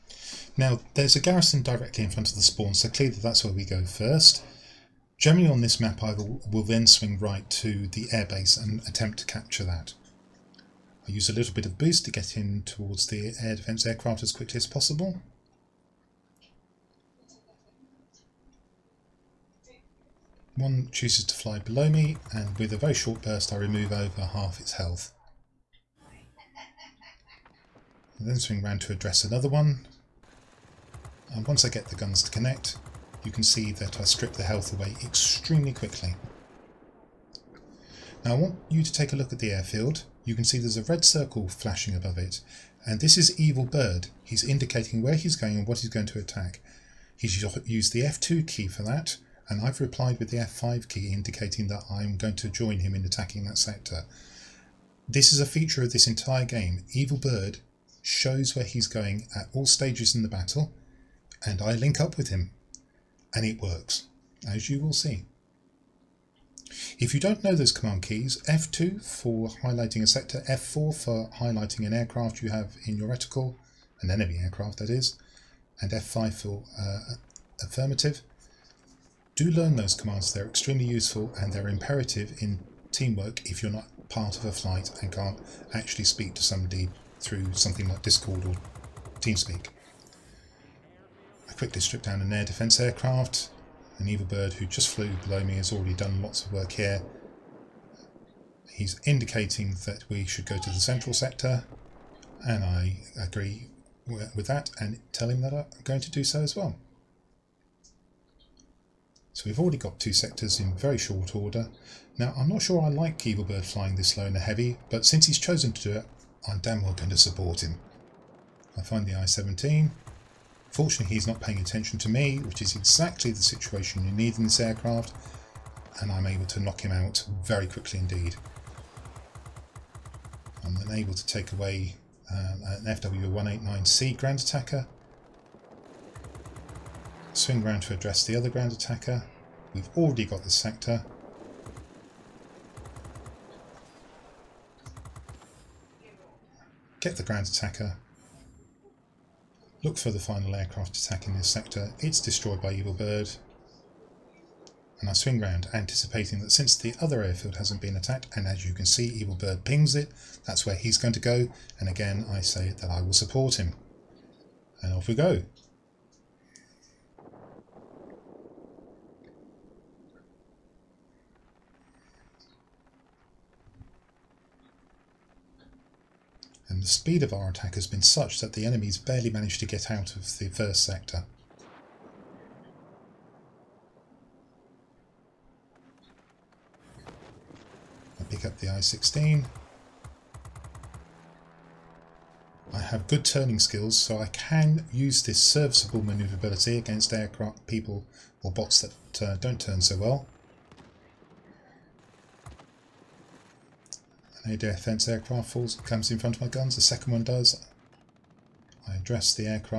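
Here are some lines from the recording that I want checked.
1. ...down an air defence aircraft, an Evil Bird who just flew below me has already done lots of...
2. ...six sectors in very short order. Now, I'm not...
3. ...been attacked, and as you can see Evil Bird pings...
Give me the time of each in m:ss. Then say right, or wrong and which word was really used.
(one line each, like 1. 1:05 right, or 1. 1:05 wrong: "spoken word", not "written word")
1. 1:32 right
2. 1:49 wrong: "two", not "six"
3. 2:37 right.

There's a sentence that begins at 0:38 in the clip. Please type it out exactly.
Now I want you to take a look at the airfield you can see there's a red circle flashing above it.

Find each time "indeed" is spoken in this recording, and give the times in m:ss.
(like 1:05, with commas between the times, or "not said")
2:07.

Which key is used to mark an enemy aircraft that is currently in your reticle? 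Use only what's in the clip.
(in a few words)
F4.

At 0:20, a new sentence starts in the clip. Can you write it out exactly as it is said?
One chooses to fly below me, and with a very short burst I remove over half its health.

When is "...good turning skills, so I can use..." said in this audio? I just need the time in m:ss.
3:13.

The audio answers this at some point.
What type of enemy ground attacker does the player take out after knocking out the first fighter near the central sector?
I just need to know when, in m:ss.
2:12.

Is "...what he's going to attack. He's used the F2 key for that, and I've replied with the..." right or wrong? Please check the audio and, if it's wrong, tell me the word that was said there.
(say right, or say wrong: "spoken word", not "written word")
right.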